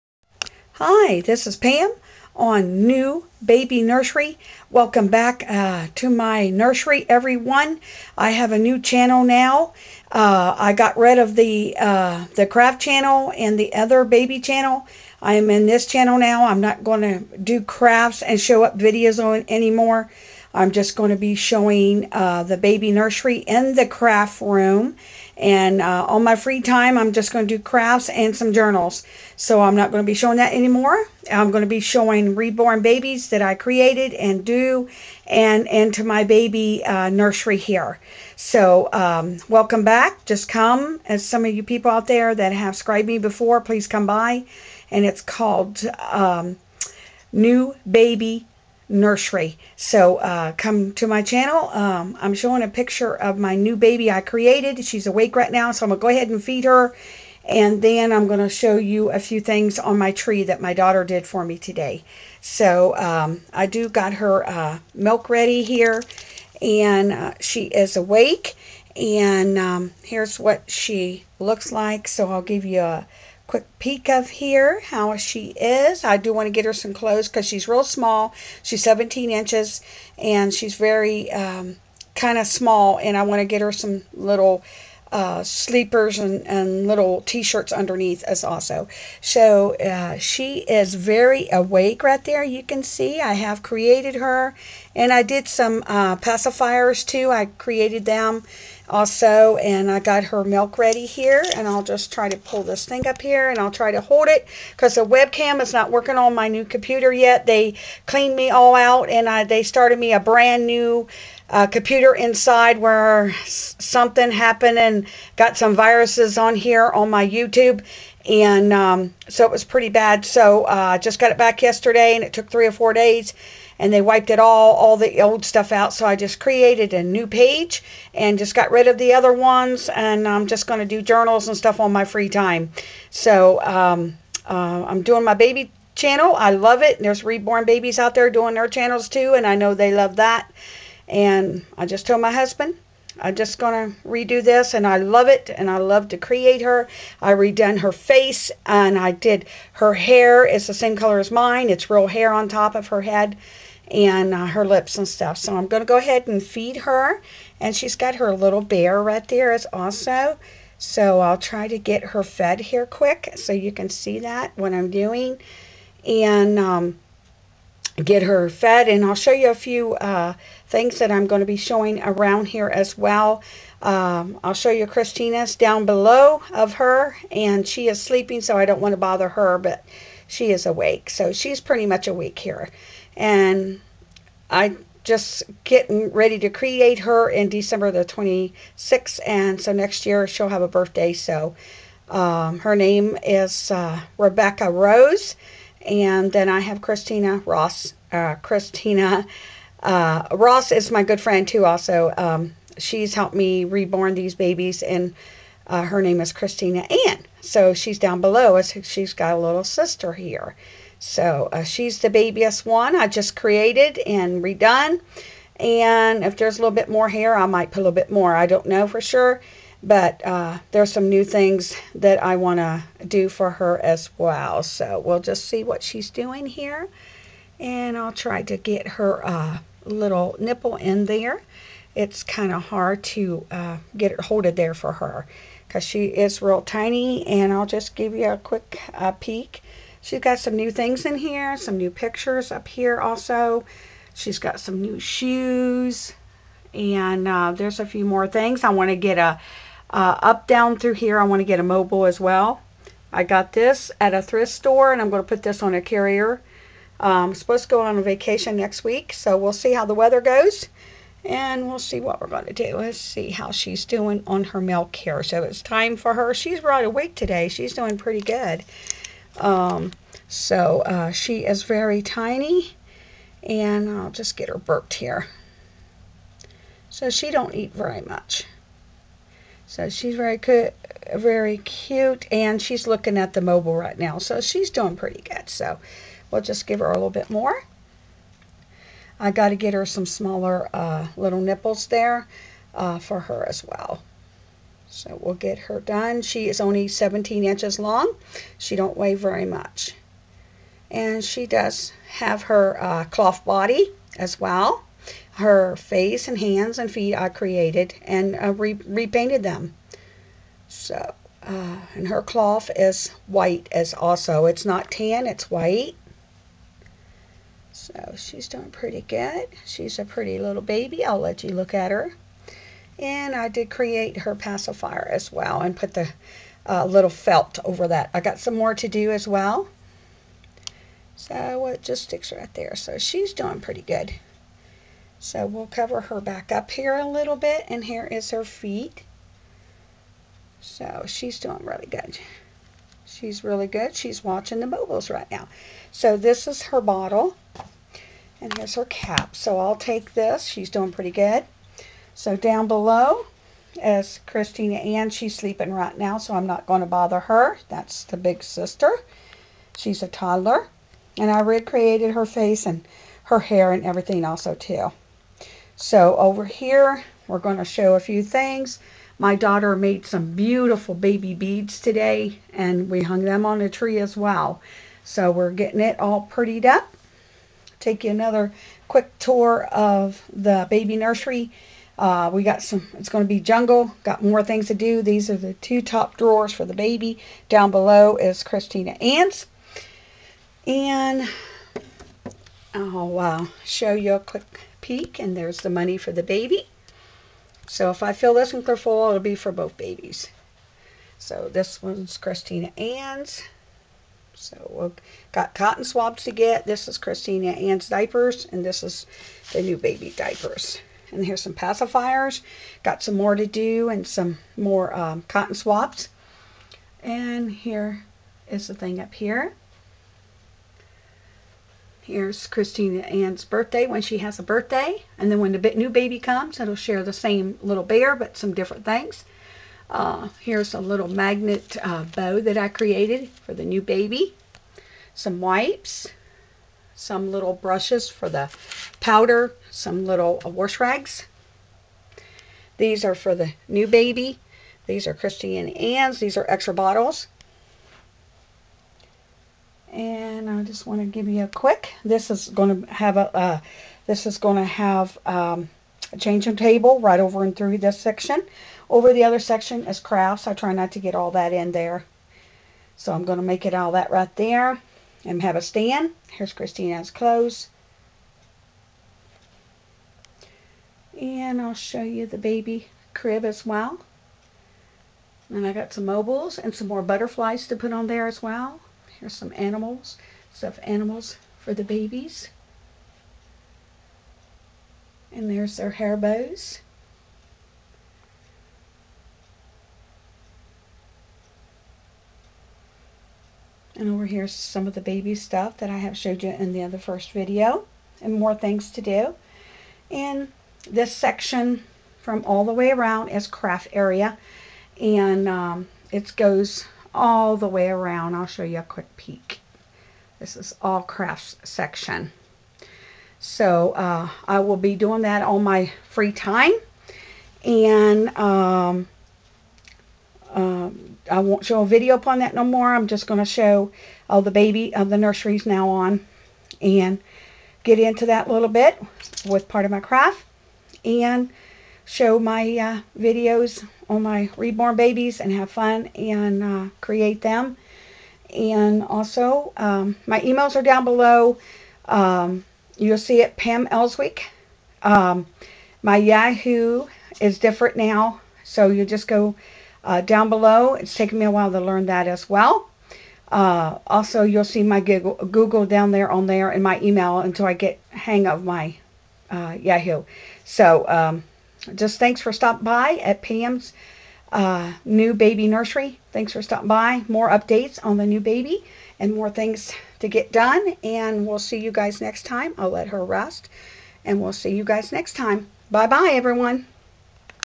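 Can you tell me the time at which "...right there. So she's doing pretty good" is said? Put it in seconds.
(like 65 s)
332 s.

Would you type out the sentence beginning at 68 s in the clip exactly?
And um, here's what she looks like.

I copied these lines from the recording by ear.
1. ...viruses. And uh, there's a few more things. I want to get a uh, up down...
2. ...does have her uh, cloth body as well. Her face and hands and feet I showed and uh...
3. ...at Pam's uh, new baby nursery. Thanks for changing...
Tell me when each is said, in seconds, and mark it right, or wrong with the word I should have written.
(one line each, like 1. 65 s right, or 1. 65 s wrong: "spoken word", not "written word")
1. 244 s wrong: "shoes", not "viruses"
2. 301 s wrong: "created", not "showed"
3. 563 s wrong: "stopping", not "changing".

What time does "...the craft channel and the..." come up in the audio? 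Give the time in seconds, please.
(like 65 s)
12 s.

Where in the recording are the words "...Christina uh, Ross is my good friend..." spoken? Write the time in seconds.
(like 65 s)
198 s.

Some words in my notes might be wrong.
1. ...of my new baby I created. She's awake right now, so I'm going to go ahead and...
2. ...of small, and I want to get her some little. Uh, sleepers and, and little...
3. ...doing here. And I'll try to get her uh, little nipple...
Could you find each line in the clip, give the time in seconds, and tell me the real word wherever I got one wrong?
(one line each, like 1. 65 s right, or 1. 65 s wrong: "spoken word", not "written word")
1. 53 s right
2. 82 s right
3. 226 s right.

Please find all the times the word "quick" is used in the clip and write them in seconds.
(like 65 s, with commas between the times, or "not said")
73 s, 162 s, 238 s, 378 s, 394 s, 451 s, 508 s.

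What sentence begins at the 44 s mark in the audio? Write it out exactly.
And it's called um, New Baby nursery.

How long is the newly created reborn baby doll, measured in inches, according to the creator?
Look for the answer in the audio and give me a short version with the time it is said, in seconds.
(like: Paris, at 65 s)
17 inches, at 78 s.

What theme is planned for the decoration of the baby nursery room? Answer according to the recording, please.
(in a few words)
Jungle.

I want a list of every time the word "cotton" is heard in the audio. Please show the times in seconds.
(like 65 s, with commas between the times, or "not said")
405 s, 415 s.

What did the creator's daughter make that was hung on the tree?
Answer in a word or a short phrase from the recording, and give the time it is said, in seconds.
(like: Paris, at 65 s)
Baby beads, at 370 s.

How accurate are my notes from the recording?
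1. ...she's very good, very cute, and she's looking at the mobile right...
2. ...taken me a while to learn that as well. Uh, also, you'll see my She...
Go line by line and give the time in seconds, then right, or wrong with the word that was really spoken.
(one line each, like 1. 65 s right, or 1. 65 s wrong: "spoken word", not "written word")
1. 279 s right
2. 551 s wrong: "Google", not "She".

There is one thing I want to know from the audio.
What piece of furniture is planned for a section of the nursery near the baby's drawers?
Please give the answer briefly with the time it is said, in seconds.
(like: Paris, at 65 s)
Changing table, at 456 s.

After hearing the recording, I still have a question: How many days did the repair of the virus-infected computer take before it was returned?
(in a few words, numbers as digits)
3 or 4 days.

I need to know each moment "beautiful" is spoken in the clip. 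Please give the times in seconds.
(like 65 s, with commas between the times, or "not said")
370 s.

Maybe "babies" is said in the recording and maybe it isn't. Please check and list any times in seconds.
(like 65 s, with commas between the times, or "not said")
32 s, 137 s, 204 s, 399 s, 481 s, 534 s.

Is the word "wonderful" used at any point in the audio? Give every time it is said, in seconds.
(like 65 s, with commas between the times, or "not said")
not said.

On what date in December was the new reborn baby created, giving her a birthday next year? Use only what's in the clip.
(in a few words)
December 26.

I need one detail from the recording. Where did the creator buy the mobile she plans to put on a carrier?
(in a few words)
Thrift store.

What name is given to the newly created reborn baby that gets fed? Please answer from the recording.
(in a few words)
Rebecca Rose.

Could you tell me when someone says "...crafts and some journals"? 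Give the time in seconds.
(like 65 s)
27 s.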